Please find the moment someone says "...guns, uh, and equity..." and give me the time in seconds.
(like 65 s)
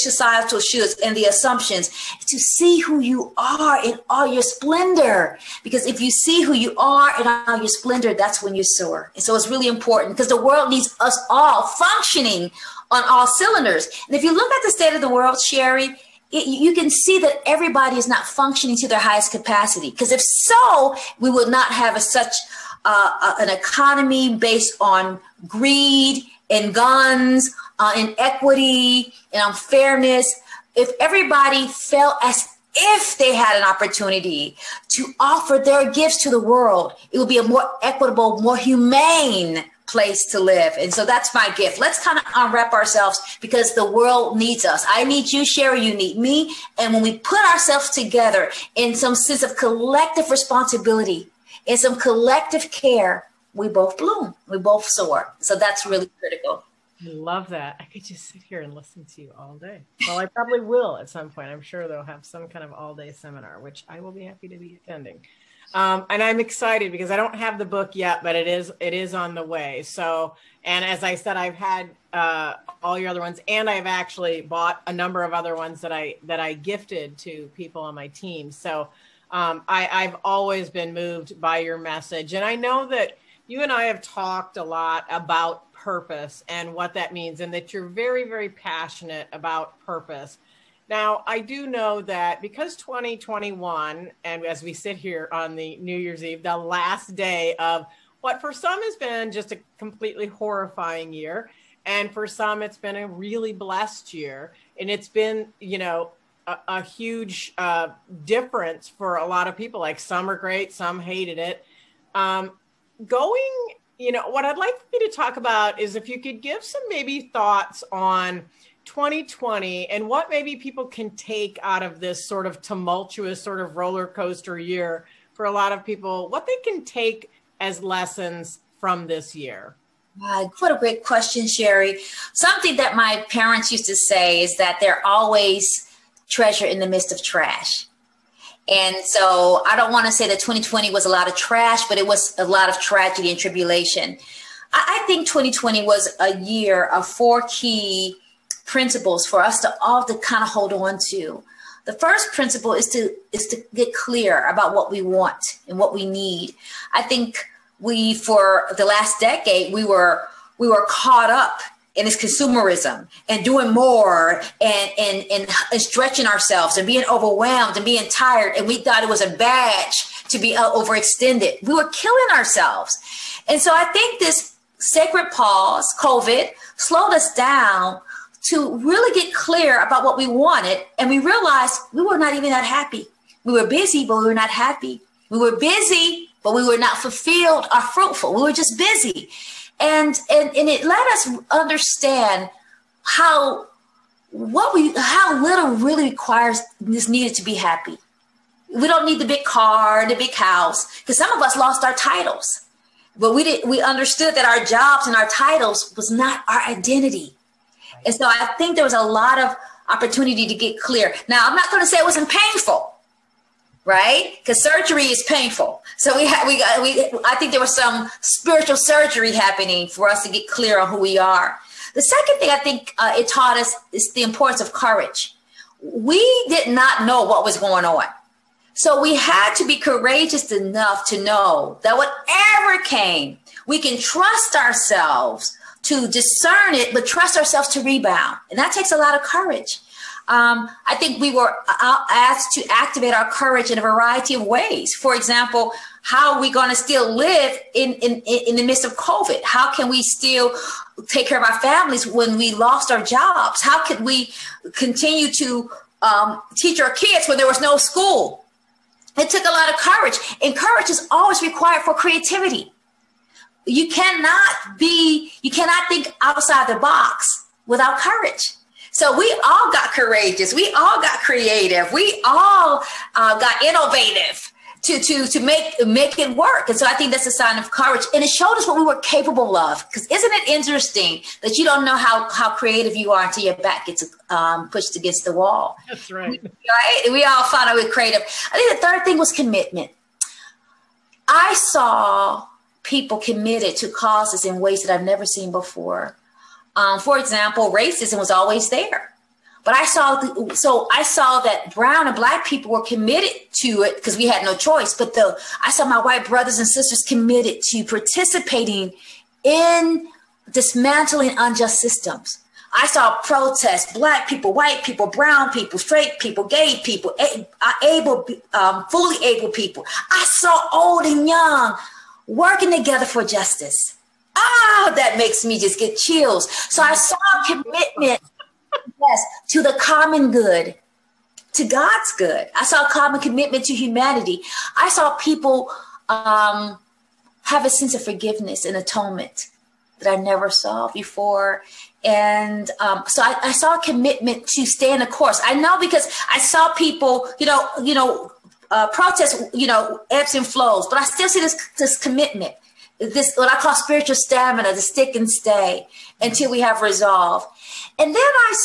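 26 s.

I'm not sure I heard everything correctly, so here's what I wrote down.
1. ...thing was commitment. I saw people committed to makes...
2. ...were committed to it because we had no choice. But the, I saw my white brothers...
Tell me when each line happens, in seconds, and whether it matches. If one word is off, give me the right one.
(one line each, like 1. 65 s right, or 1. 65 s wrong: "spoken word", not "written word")
1. 289 s wrong: "causes", not "makes"
2. 302 s right.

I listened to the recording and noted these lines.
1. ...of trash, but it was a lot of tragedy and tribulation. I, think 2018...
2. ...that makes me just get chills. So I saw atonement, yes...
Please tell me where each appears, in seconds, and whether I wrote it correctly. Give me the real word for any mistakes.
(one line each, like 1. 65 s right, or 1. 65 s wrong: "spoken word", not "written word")
1. 141 s wrong: "2020", not "2018"
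2. 324 s wrong: "commitment", not "atonement".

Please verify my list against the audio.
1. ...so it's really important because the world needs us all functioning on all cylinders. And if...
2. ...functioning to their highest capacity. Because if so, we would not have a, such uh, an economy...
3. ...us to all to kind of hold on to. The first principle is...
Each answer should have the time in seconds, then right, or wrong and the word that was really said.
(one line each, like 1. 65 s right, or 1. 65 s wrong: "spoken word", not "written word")
1. 9 s right
2. 18 s right
3. 149 s right.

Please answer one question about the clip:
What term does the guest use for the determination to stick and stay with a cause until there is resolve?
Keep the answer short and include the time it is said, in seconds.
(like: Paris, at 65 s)
spiritual stamina, at 353 s.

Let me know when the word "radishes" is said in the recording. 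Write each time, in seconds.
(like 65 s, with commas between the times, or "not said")
not said.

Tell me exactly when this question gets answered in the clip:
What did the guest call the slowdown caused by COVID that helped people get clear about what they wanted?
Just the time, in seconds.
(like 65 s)
174 s.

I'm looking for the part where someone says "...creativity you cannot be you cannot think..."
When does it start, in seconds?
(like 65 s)
261 s.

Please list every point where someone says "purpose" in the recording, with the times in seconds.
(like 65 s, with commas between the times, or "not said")
85 s, 89 s.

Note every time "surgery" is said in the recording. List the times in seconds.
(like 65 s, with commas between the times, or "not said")
214 s, 218 s.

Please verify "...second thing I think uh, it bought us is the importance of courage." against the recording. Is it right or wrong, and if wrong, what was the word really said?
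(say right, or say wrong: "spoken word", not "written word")
wrong: "taught", not "bought".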